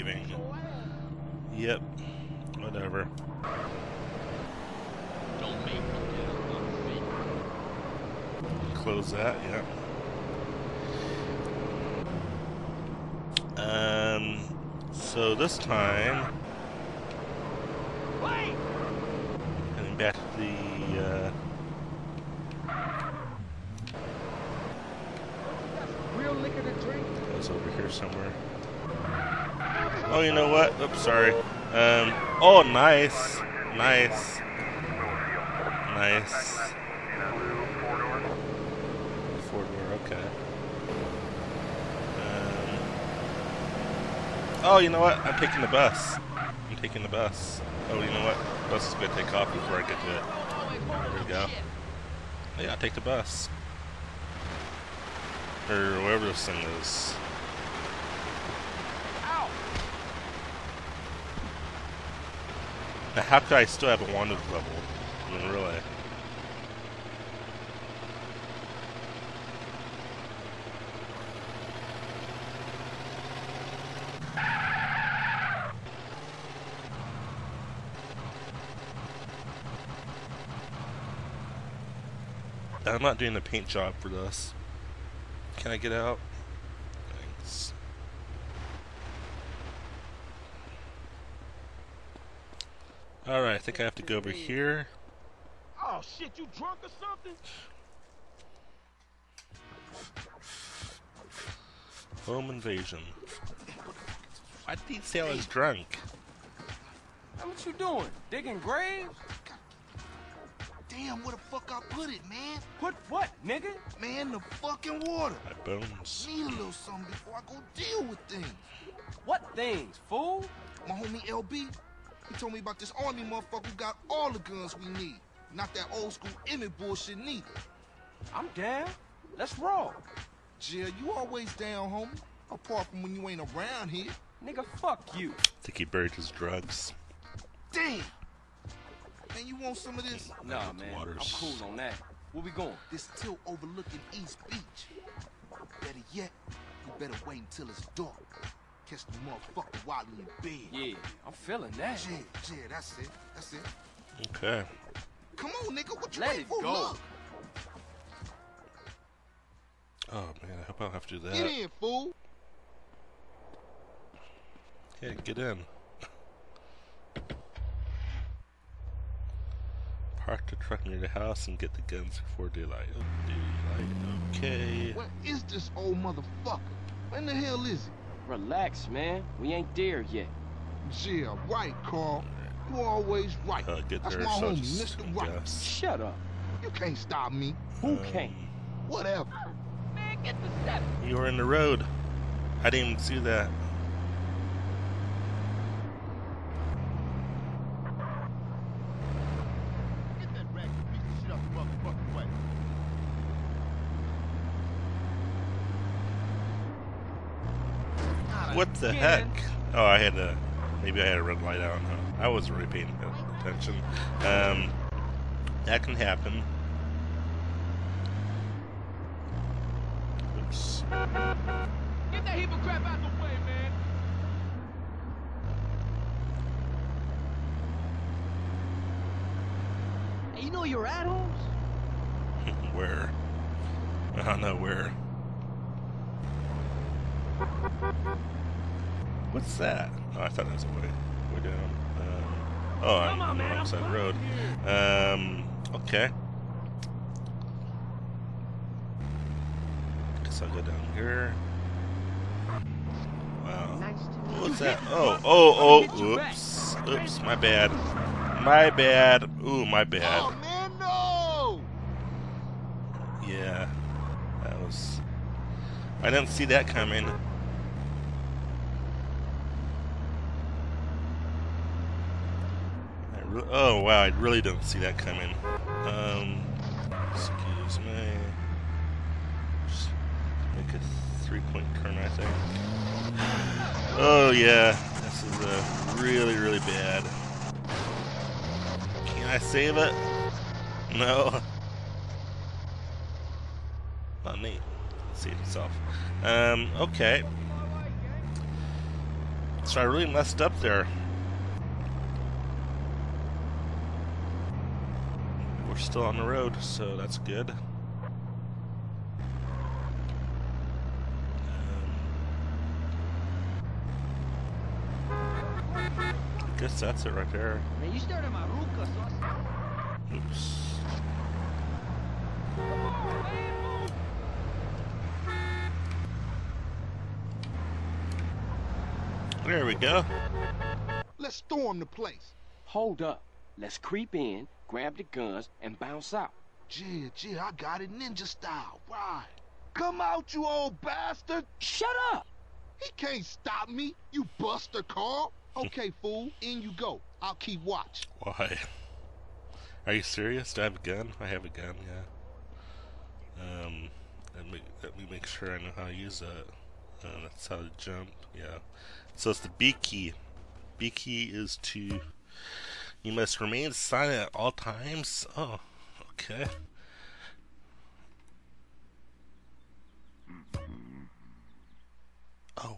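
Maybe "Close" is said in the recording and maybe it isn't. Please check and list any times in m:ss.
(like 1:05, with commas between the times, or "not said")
0:08.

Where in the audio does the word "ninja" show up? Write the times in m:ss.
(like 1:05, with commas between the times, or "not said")
5:37.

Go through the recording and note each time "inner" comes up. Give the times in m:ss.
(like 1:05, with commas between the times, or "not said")
not said.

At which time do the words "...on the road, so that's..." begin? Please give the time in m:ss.
5:06.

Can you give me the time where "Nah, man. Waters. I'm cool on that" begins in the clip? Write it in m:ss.
2:20.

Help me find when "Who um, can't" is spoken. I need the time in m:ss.
3:07.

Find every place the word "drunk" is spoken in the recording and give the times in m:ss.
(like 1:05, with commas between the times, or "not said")
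1:36, 1:45.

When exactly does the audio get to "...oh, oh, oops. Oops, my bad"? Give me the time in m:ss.
4:15.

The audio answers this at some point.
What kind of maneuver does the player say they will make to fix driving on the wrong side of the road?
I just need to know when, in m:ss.
4:41.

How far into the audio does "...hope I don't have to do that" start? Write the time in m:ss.
2:40.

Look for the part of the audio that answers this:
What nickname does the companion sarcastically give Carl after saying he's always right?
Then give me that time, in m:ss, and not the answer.
3:04.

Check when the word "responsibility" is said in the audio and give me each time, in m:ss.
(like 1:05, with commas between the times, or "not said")
not said.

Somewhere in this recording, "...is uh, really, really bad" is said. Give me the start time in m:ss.
4:45.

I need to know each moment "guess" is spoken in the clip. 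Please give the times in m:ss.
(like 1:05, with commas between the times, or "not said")
4:10, 5:16.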